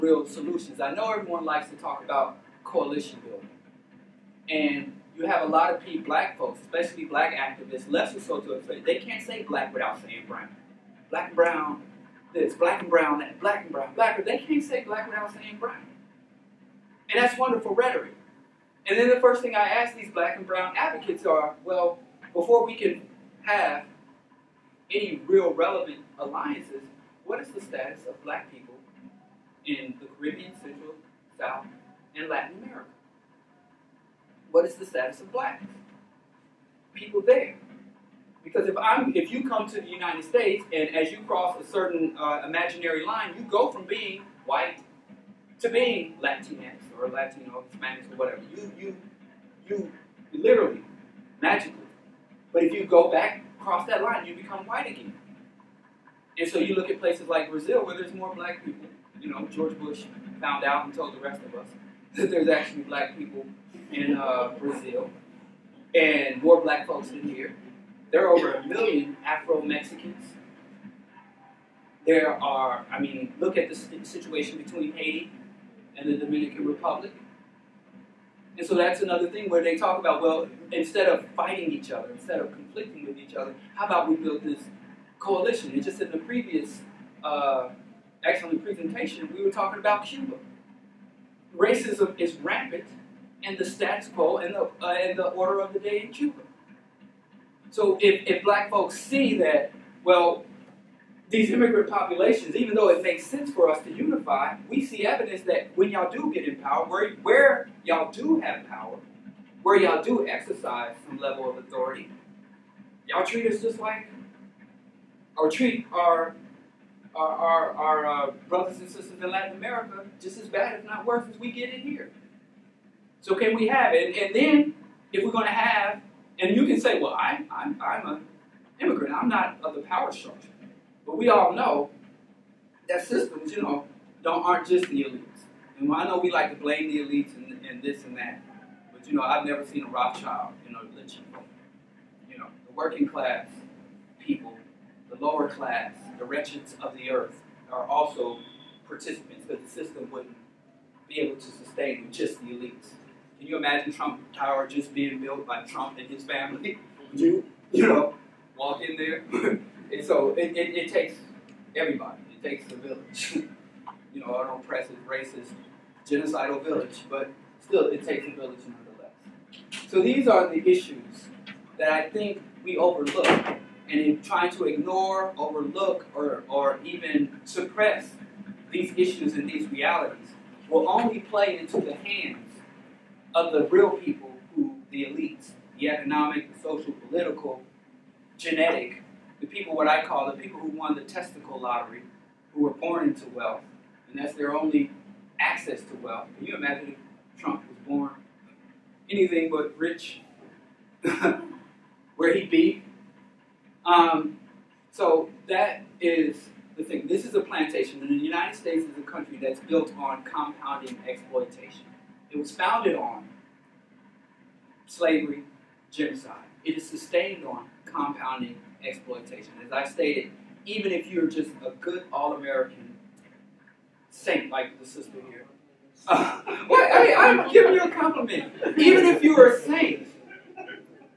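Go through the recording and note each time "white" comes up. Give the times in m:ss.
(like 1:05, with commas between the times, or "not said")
0:44, 0:54.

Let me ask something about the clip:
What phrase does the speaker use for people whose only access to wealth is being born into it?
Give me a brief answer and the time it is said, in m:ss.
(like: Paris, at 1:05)
testicle lottery, at 3:11.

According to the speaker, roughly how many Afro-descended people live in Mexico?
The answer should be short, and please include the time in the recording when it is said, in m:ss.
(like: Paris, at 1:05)
over 1 million, at 1:08.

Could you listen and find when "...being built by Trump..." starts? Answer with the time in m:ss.
2:34.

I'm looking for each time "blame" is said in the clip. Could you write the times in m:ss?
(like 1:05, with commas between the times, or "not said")
2:16.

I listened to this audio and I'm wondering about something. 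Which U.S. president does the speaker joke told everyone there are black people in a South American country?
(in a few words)
George Bush.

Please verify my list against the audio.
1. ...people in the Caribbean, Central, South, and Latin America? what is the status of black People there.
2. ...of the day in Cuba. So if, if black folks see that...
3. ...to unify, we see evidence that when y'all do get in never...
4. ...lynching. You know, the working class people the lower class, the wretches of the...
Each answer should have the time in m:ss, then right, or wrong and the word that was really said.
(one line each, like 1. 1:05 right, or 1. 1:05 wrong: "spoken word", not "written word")
1. 0:28 right
2. 1:35 right
3. 1:43 wrong: "power", not "never"
4. 2:20 right.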